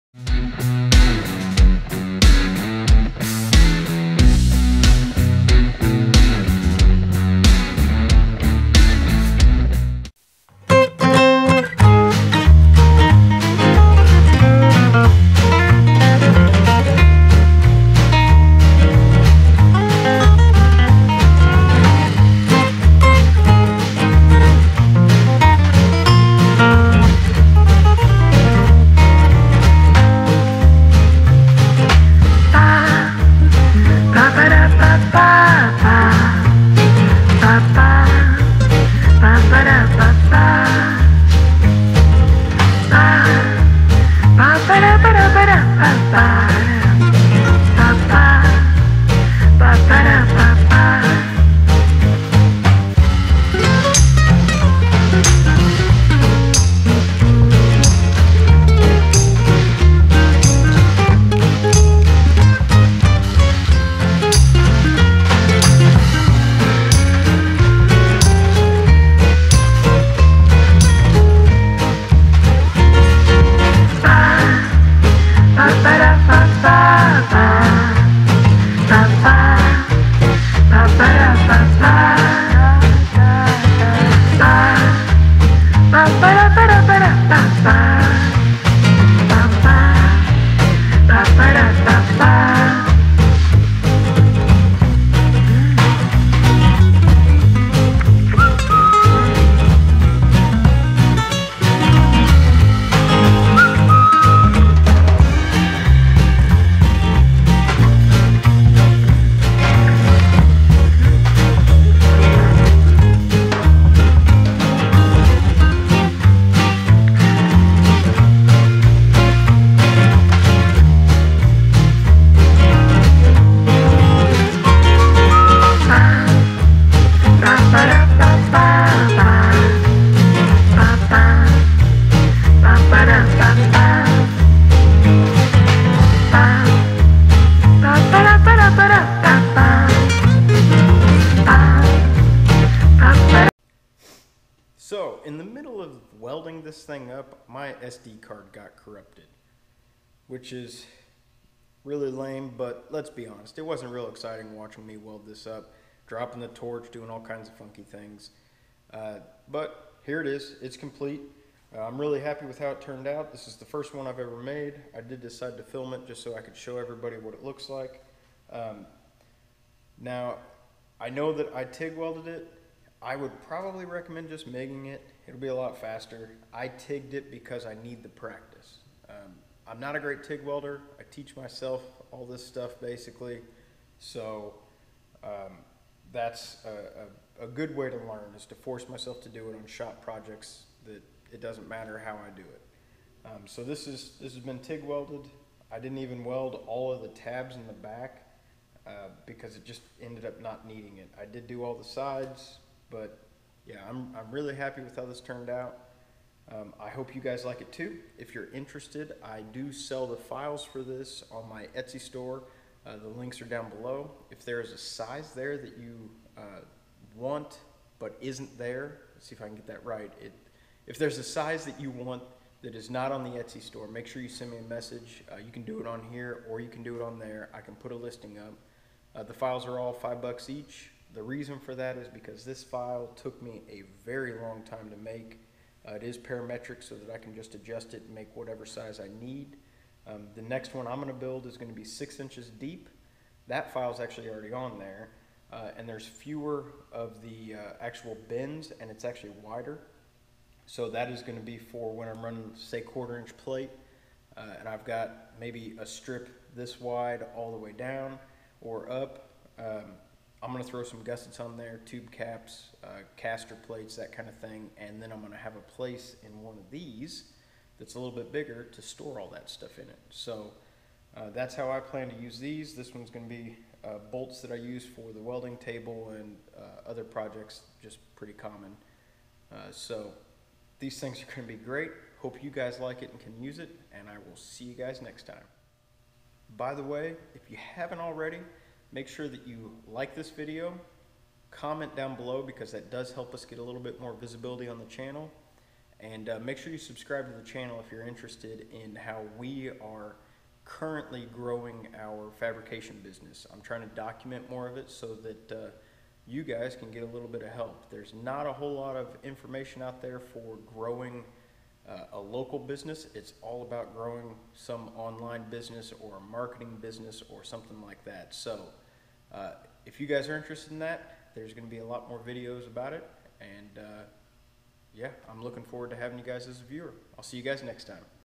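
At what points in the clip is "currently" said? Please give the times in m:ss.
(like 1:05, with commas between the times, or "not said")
5:00.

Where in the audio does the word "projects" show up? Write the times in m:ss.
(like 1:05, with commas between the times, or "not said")
3:10, 4:37.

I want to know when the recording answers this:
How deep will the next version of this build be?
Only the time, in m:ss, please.
4:01.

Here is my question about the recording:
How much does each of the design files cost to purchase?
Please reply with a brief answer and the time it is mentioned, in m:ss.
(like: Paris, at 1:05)
$5, at 3:49.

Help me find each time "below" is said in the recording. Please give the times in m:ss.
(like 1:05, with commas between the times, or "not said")
3:33, 4:52.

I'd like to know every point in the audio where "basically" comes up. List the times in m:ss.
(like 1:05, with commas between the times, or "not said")
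3:02.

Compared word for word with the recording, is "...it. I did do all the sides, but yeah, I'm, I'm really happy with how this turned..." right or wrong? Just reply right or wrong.
right.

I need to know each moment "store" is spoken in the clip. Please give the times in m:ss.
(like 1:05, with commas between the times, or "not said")
3:32, 3:43, 4:28.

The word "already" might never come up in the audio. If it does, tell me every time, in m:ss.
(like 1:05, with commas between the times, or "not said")
4:04, 4:47.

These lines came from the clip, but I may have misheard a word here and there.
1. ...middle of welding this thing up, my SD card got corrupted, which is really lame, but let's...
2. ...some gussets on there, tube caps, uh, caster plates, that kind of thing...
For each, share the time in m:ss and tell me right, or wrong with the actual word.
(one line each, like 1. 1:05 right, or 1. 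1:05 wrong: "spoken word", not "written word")
1. 2:25 right
2. 4:20 right.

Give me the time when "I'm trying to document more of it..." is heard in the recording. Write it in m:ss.
5:03.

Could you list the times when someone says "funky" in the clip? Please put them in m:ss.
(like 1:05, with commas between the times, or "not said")
2:37.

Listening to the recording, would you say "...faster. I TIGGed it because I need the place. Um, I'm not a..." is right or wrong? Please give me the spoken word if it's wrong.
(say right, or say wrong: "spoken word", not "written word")
wrong: "practice", not "place".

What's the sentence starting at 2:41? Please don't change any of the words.
Uh, I'm really happy with how it turned out.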